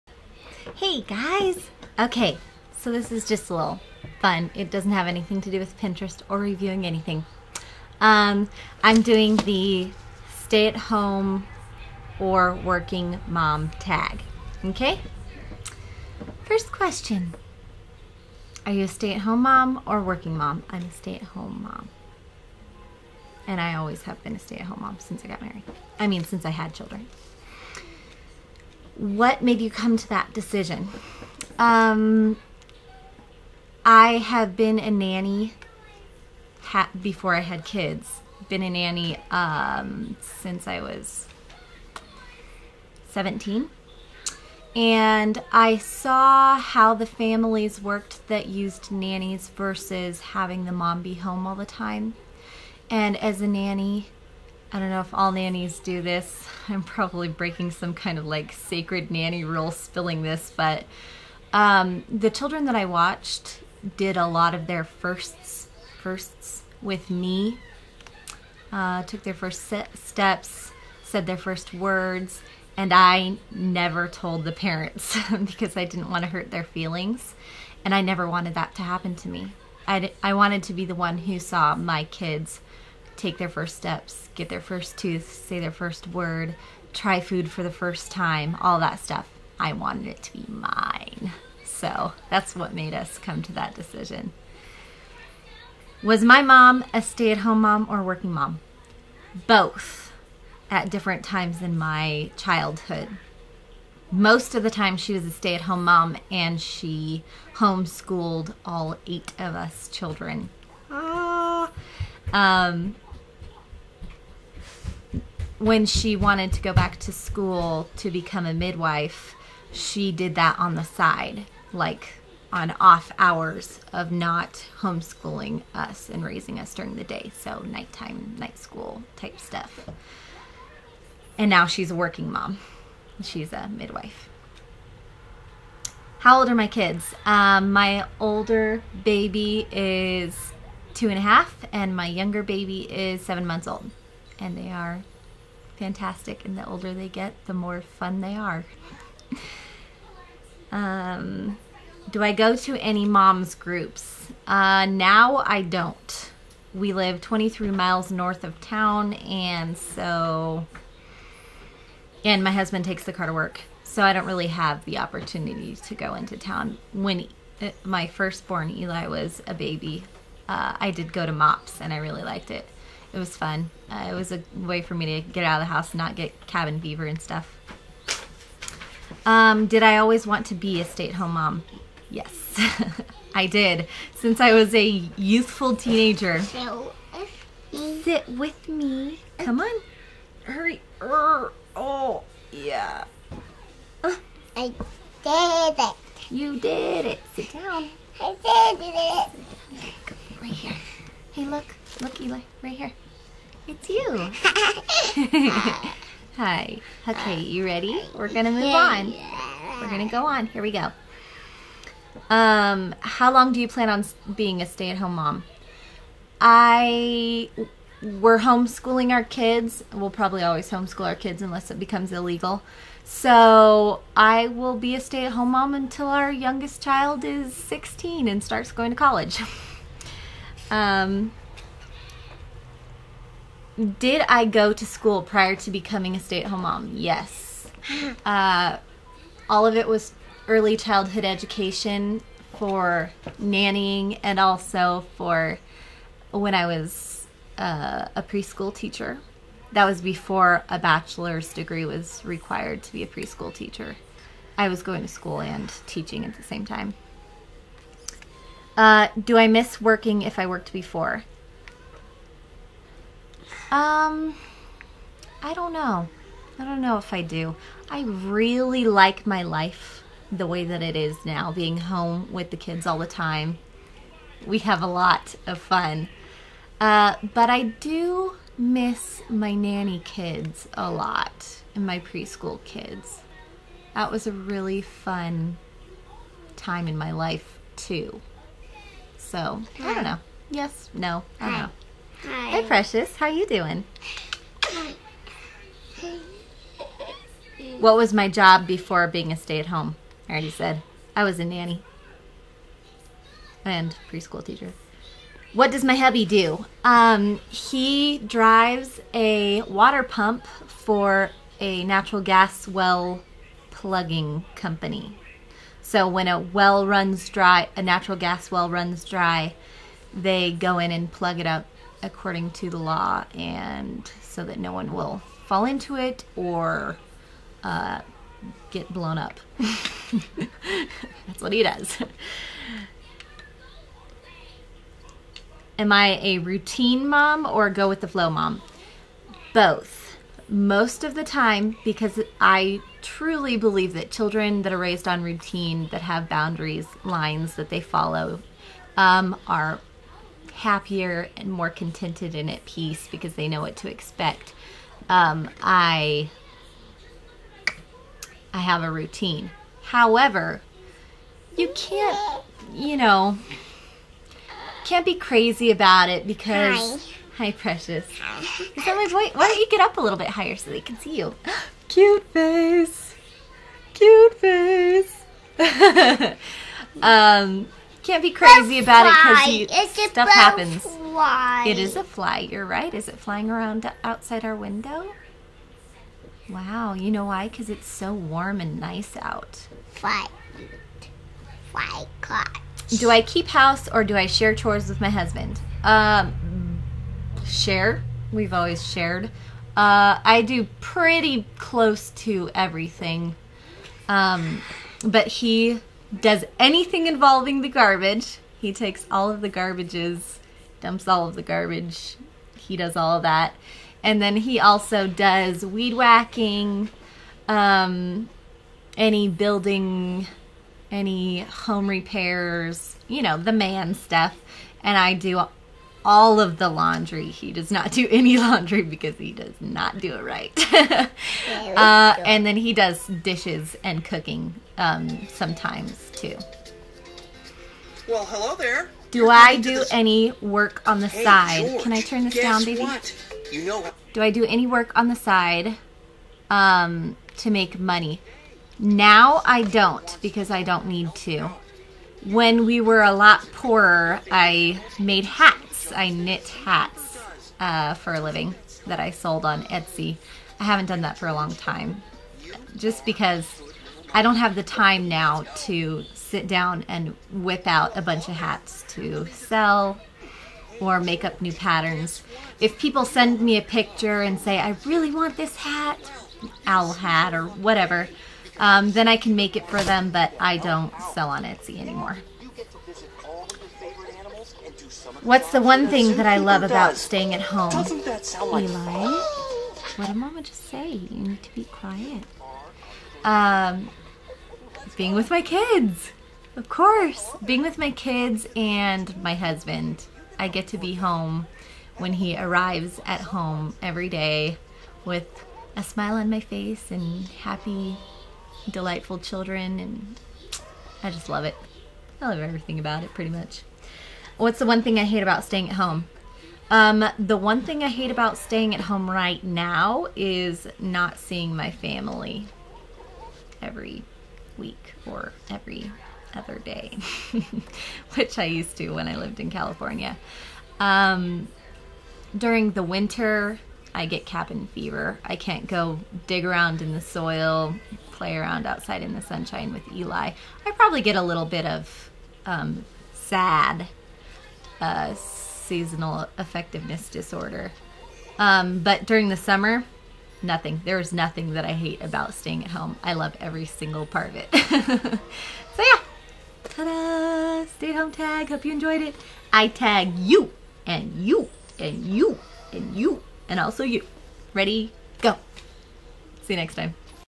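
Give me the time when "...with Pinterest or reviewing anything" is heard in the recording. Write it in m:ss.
0:05.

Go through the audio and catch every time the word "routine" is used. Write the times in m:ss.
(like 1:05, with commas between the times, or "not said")
5:36, 5:45, 5:58.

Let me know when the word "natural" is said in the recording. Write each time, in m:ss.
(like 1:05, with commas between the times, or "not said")
5:11, 5:17.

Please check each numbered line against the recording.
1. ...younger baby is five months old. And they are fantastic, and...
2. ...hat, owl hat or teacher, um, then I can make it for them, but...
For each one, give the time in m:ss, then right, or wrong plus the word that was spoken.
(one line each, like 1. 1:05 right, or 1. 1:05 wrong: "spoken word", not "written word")
1. 2:22 wrong: "seven", not "five"
2. 7:55 wrong: "whatever", not "teacher".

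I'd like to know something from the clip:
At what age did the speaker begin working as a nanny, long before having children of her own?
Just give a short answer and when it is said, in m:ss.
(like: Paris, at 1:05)
17, at 0:43.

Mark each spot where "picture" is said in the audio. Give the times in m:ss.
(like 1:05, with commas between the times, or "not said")
7:53.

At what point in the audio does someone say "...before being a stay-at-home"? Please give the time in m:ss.
4:58.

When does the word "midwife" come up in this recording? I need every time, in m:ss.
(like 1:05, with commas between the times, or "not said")
1:58, 2:13.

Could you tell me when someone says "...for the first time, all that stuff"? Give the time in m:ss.
1:27.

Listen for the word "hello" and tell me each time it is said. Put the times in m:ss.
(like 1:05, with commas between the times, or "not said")
7:18.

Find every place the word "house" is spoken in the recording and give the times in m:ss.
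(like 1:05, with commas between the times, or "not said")
2:55, 6:33.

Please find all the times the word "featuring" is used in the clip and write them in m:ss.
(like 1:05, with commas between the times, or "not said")
not said.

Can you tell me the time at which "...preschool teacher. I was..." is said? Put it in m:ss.
4:13.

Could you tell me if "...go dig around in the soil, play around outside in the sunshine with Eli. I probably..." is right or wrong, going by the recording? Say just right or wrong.
right.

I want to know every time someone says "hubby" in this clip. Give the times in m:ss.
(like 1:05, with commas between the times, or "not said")
5:05.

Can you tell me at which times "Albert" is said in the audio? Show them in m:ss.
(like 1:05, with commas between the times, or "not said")
not said.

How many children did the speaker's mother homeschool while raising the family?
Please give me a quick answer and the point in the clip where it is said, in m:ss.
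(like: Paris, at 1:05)
8, at 1:49.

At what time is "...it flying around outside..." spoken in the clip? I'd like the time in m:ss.
6:23.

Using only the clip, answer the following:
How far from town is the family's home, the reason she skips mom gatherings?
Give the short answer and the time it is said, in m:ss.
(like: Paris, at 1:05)
23 miles, at 2:37.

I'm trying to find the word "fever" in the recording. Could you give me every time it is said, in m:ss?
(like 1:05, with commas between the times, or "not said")
2:56, 8:54.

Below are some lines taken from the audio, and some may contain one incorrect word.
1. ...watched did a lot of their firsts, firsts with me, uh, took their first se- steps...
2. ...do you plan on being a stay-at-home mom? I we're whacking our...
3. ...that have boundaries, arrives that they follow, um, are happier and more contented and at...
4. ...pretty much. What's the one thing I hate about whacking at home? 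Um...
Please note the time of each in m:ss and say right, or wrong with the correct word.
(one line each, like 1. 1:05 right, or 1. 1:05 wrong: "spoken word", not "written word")
1. 1:02 right
2. 3:33 wrong: "homeschooling", not "whacking"
3. 5:45 wrong: "lines", not "arrives"
4. 8:33 wrong: "staying", not "whacking".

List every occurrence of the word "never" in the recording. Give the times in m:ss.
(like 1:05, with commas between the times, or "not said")
1:13, 1:18.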